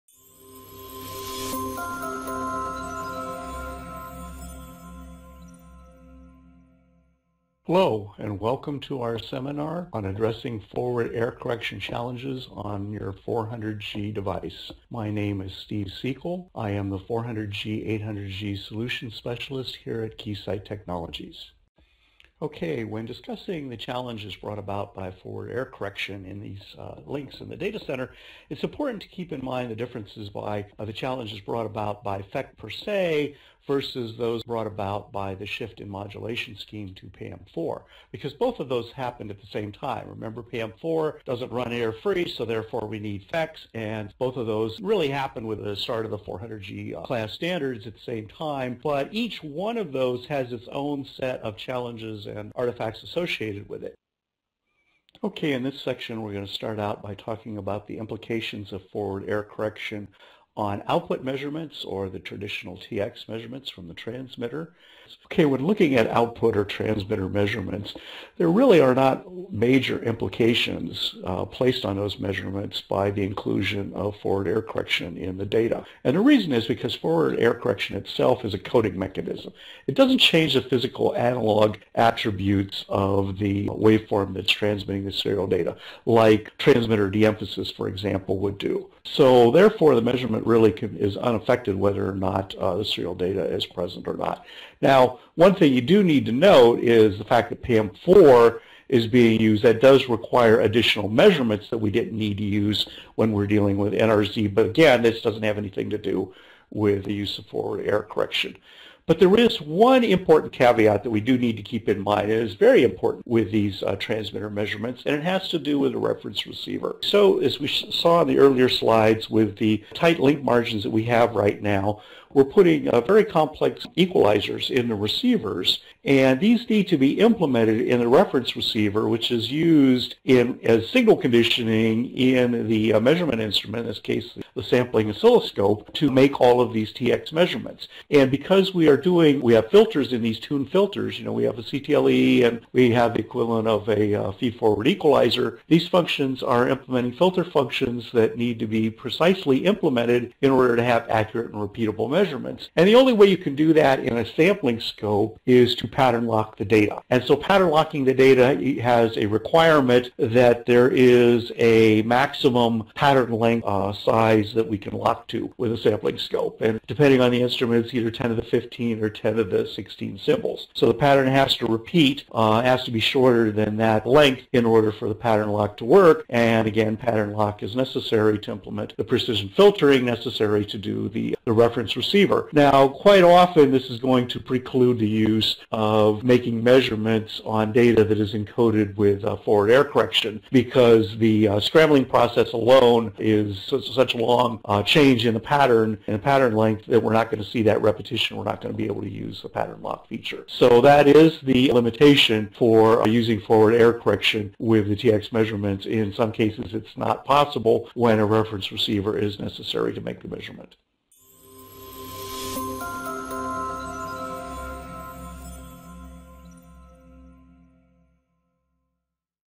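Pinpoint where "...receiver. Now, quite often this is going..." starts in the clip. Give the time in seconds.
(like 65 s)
182 s.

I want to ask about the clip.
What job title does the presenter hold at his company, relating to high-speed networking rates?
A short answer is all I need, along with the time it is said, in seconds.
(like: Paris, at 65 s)
400G 800G solution specialist, at 16 s.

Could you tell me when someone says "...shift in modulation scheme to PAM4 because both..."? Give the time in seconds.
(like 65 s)
35 s.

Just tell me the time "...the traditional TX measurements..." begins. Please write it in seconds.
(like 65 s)
62 s.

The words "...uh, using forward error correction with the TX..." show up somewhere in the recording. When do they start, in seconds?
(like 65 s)
203 s.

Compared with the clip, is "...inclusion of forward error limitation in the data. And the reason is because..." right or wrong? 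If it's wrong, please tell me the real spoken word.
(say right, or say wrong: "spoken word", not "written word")
wrong: "correction", not "limitation".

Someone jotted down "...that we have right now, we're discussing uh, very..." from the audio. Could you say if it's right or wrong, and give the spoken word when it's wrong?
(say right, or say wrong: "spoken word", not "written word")
wrong: "putting", not "discussing".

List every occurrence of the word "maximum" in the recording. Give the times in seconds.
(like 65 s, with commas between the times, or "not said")
162 s.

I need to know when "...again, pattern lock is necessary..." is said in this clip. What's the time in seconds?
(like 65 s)
176 s.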